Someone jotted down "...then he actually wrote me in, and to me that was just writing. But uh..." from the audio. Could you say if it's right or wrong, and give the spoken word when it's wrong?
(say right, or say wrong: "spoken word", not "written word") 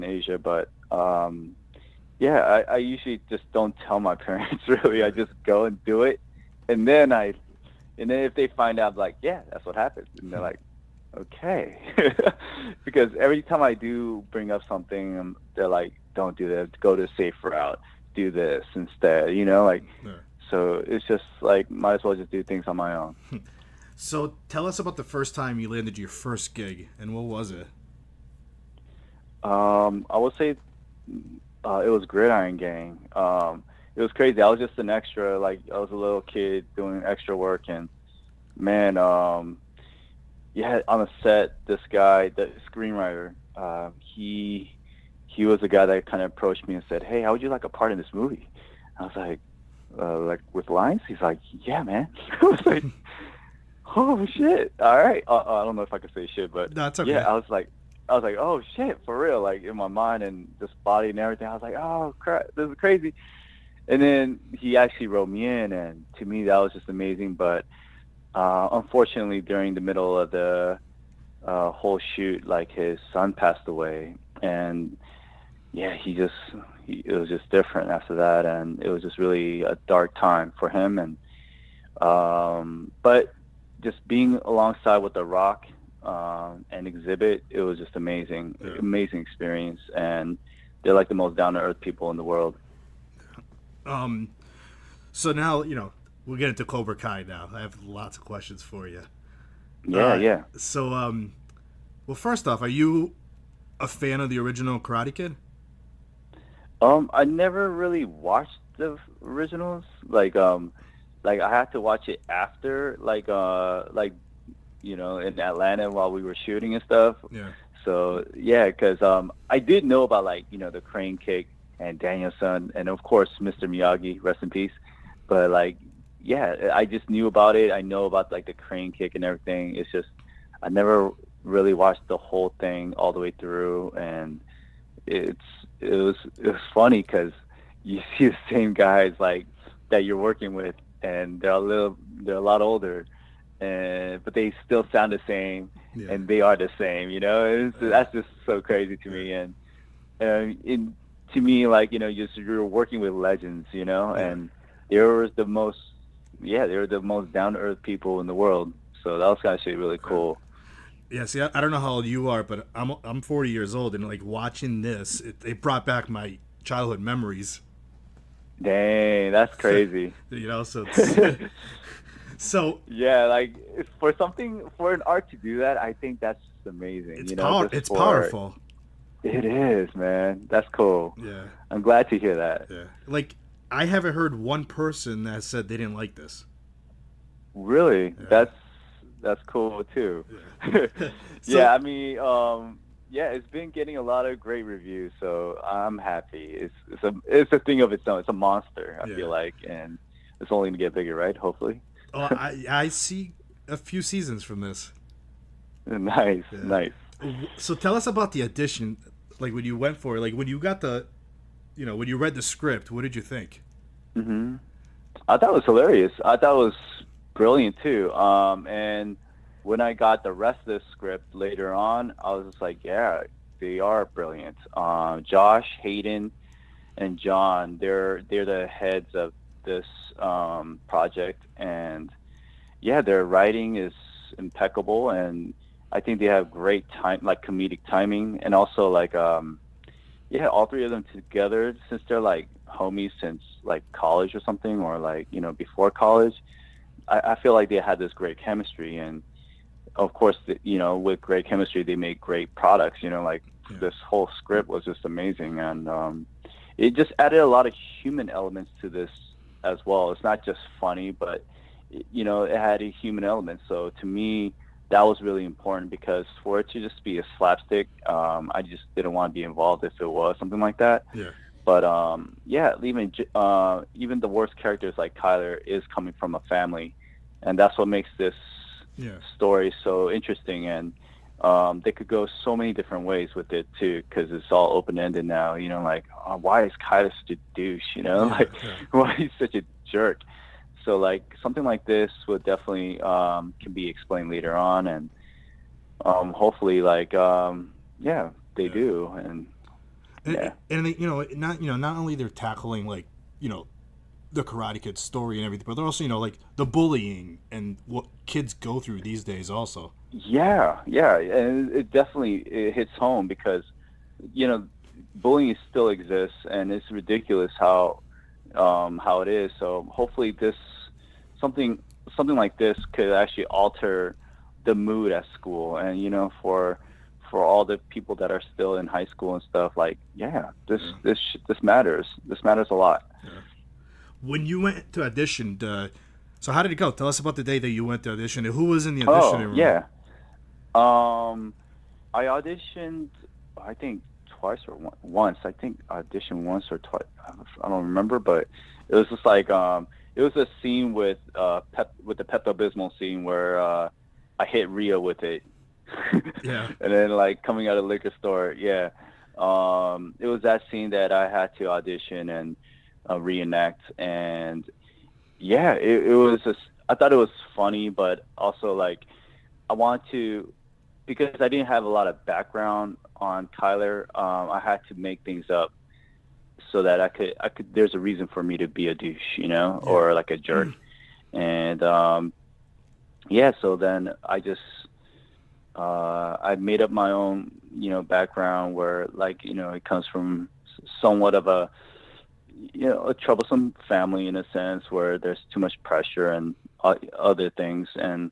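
wrong: "amazing", not "writing".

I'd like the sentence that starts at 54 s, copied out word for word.
All right." Uh, uh, I don't know if I can say shit, but no, okay.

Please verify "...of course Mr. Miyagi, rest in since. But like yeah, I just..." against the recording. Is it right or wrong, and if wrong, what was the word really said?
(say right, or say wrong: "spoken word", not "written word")
wrong: "peace", not "since".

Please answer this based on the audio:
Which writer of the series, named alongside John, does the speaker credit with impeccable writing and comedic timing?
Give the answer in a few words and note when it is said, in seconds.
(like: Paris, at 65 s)
Josh Hayden, at 225 s.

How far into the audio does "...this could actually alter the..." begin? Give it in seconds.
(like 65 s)
322 s.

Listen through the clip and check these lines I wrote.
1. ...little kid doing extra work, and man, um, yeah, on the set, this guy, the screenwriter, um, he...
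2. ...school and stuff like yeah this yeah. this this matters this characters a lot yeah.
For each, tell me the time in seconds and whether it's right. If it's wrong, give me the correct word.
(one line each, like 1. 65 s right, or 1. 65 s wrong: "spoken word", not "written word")
1. 35 s right
2. 329 s wrong: "matters", not "characters".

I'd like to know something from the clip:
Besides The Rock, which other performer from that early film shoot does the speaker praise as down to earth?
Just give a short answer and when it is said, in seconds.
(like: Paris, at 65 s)
Xzibit, at 86 s.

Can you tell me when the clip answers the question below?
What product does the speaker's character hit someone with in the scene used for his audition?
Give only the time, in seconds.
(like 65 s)
352 s.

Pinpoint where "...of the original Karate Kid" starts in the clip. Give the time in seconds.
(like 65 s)
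104 s.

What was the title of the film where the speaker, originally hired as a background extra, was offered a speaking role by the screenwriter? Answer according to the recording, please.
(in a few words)
Gridiron Gang.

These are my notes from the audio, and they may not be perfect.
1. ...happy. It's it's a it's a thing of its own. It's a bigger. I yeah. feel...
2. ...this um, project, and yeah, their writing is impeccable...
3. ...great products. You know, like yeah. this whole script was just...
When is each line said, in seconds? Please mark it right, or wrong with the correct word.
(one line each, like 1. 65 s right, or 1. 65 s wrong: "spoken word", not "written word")
1. 195 s wrong: "monster", not "bigger"
2. 229 s right
3. 252 s right.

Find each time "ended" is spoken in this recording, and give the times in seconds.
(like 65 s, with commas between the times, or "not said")
284 s.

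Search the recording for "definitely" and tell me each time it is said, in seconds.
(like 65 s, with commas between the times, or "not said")
292 s, 311 s.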